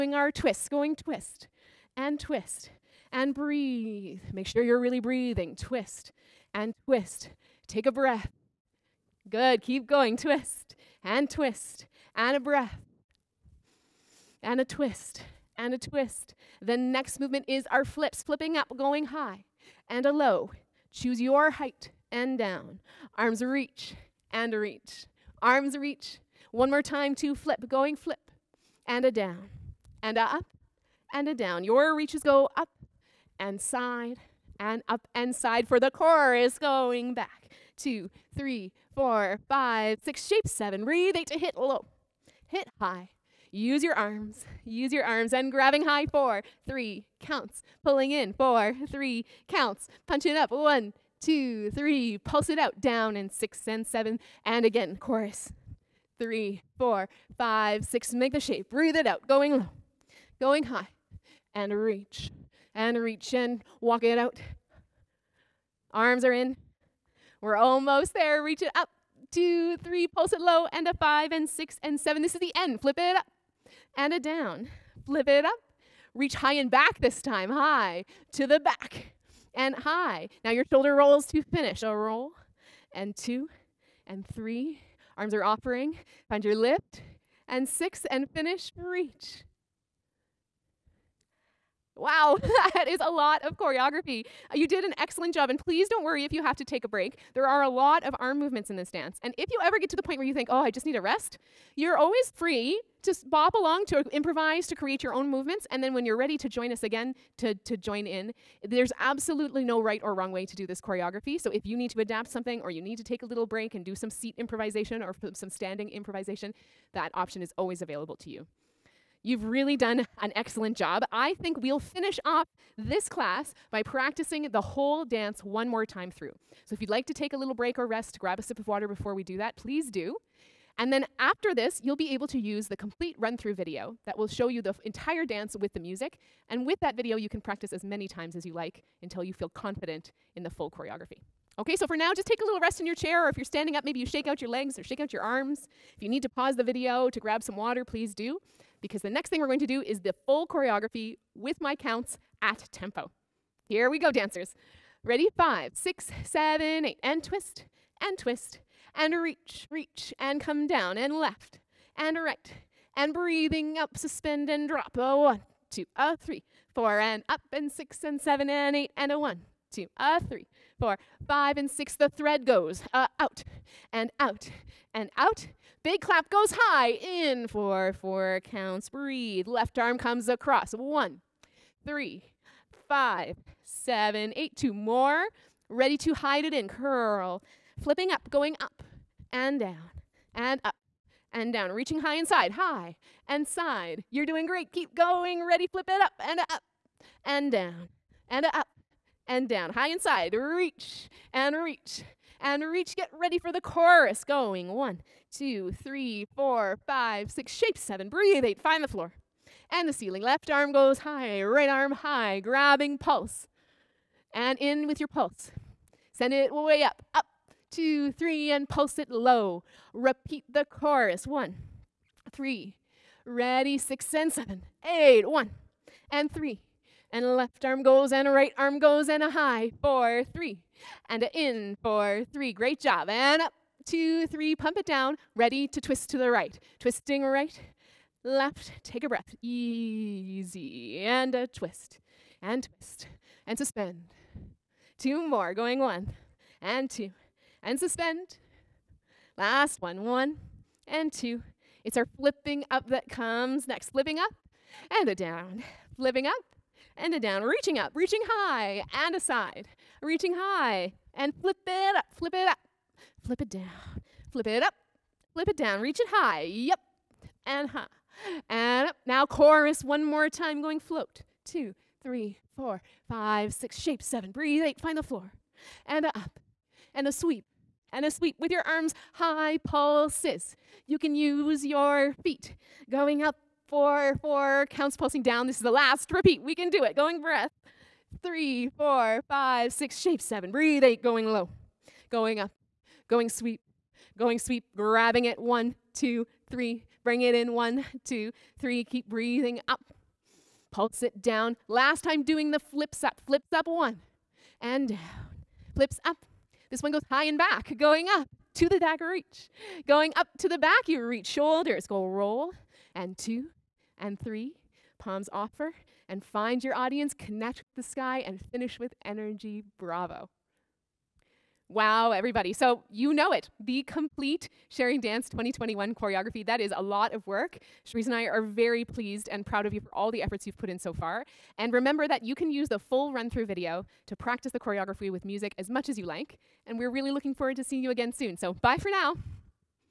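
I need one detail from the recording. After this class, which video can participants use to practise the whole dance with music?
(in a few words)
Complete run-through video.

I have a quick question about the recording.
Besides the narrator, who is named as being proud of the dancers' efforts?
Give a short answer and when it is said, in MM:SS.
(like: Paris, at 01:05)
Sharice, at 05:27.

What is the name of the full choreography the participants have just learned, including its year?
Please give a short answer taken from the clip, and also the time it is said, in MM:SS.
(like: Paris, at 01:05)
Sharing Dance 2021, at 05:24.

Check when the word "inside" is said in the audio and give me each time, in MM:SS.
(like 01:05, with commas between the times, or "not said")
03:12, 03:19.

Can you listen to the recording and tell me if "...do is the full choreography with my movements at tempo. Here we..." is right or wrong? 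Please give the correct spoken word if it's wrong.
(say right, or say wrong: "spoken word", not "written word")
wrong: "counts", not "movements".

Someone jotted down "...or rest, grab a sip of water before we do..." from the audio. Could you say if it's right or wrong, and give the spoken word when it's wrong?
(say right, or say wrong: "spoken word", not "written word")
right.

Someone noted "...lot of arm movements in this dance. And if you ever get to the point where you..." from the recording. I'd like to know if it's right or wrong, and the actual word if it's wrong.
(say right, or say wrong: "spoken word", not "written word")
right.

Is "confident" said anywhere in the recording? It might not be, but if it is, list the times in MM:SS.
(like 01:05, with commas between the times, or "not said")
02:19.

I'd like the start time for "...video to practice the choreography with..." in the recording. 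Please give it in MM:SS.
05:33.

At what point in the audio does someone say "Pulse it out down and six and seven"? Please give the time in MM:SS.
00:52.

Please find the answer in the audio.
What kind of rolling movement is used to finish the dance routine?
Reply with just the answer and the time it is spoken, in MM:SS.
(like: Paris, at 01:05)
Shoulder rolls, at 01:20.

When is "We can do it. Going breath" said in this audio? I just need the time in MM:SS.
04:46.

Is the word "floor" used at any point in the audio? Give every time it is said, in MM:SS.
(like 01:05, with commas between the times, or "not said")
03:28, 04:35.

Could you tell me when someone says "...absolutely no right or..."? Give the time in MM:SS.
01:48.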